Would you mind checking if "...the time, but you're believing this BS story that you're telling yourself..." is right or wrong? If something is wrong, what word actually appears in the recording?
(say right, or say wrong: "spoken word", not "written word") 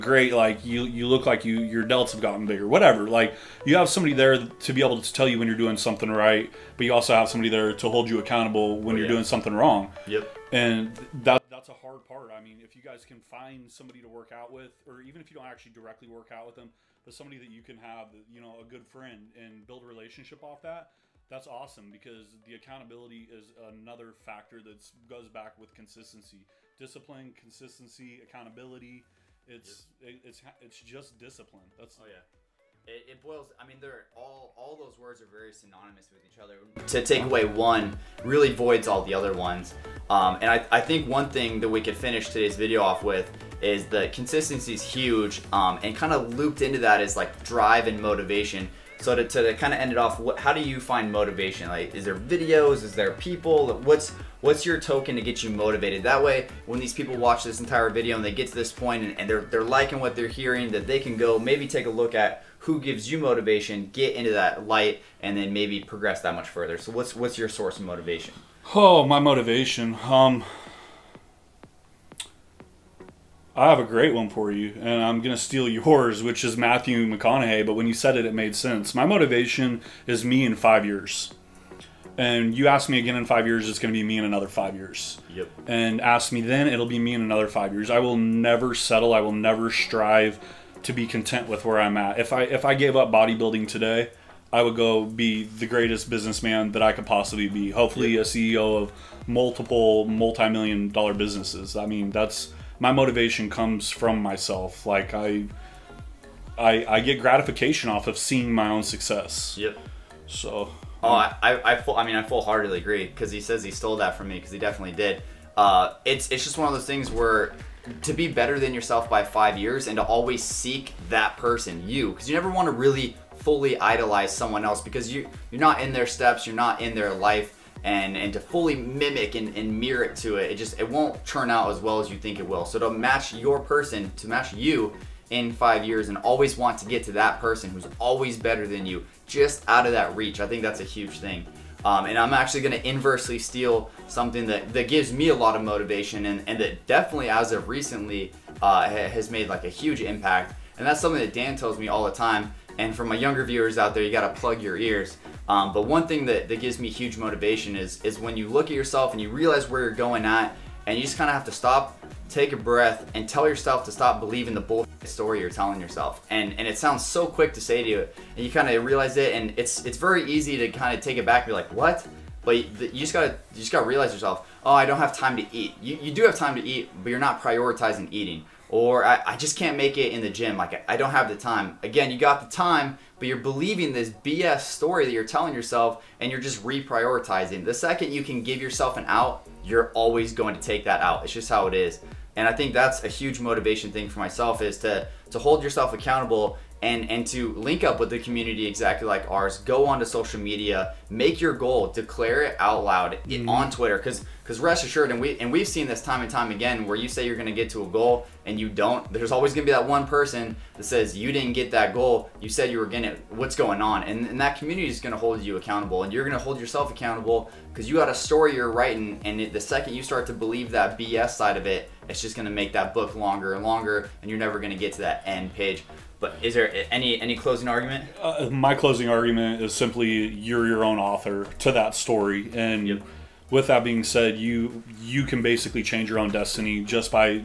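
right.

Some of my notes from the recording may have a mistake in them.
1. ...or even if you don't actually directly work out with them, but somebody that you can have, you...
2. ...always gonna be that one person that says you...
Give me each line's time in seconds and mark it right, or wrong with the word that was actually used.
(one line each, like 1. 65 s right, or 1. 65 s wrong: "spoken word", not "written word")
1. 14 s right
2. 209 s right.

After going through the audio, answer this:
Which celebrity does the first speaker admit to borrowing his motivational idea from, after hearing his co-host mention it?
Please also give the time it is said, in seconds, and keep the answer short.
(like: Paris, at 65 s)
Matthew McConaughey, at 76 s.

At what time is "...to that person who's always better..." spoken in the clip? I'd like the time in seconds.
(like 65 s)
137 s.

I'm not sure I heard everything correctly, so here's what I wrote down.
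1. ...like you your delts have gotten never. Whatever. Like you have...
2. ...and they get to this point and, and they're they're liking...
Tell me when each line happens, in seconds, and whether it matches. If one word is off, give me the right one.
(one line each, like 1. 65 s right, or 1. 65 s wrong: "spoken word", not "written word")
1. 1 s wrong: "bigger", not "never"
2. 58 s right.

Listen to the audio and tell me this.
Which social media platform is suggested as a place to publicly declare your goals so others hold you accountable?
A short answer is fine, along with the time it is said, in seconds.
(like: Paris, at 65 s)
Twitter, at 203 s.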